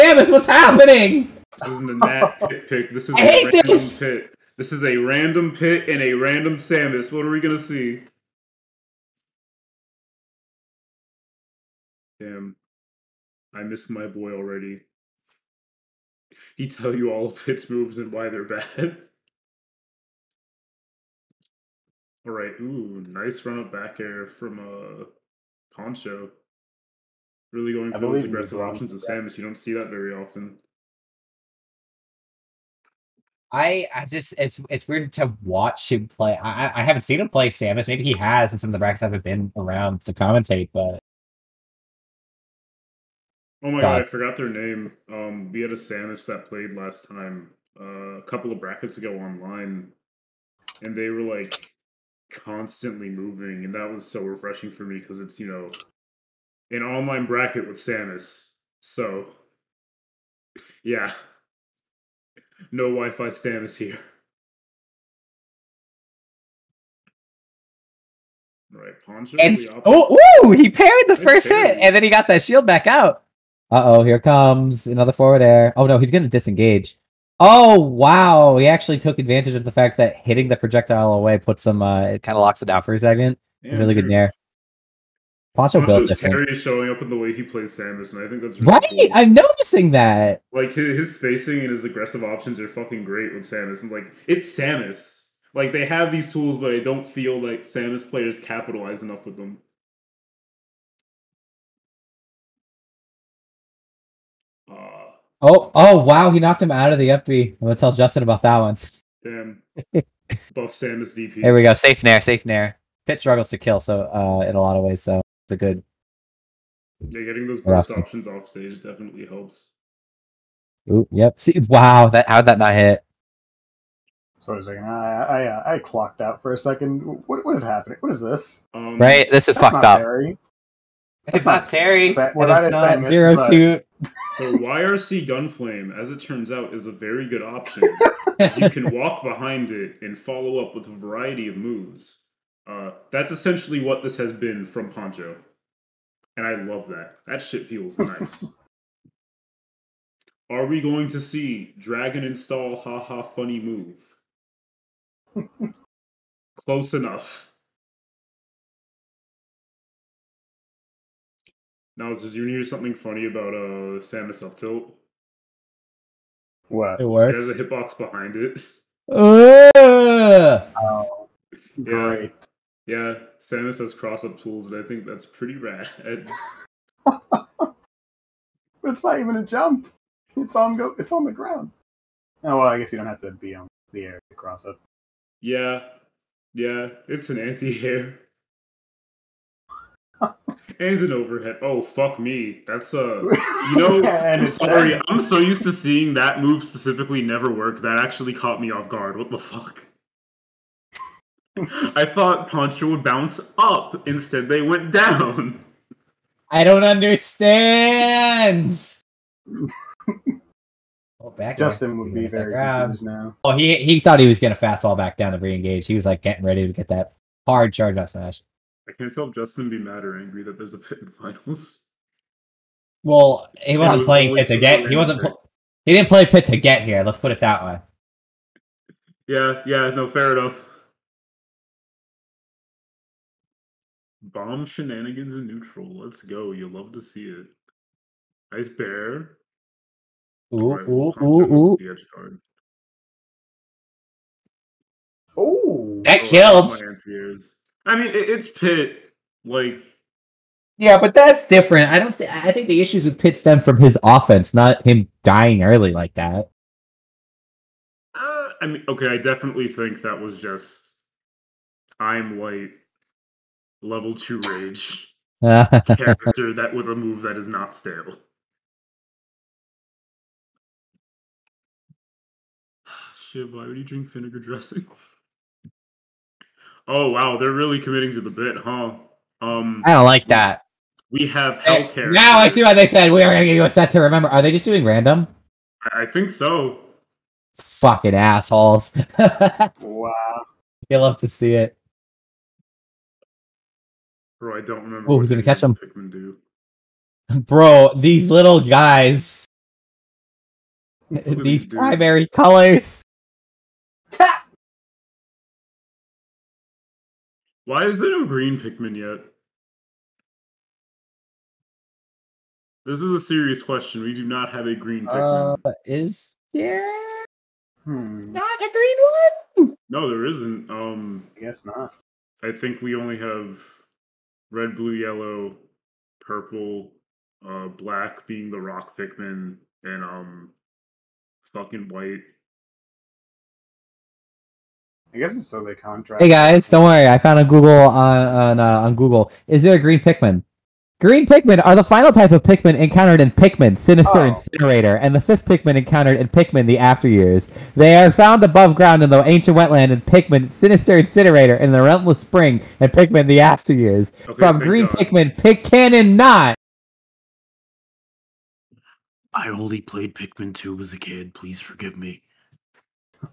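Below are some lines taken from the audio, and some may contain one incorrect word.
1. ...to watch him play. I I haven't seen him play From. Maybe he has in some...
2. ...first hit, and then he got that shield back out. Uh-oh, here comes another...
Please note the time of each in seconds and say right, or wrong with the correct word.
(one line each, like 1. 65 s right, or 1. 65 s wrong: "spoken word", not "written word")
1. 35 s wrong: "Samus", not "From"
2. 71 s right.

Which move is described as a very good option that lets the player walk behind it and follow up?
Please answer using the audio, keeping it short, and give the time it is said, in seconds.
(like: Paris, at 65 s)
YRC Gunflame, at 134 s.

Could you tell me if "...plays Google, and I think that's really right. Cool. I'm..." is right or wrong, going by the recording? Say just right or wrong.
wrong.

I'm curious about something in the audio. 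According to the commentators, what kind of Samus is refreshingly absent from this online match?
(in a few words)
Wi-Fi Samus.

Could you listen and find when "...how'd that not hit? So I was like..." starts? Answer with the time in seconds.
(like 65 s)
122 s.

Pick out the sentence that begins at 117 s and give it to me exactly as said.
Yeah, getting those burst options off stage definitely helps.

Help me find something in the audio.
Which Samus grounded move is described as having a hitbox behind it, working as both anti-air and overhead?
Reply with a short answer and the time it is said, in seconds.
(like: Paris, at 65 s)
up tilt, at 164 s.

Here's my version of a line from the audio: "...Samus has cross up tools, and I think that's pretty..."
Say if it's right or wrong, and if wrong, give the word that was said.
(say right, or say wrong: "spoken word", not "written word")
right.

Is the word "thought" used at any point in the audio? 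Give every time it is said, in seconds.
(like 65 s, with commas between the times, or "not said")
202 s, 213 s.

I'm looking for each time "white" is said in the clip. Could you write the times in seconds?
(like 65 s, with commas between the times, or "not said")
262 s, 331 s.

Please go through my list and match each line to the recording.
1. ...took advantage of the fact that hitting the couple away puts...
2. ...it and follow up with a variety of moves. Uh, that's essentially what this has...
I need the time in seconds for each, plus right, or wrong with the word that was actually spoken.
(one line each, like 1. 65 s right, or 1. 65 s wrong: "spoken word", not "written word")
1. 78 s wrong: "projectile", not "couple"
2. 139 s right.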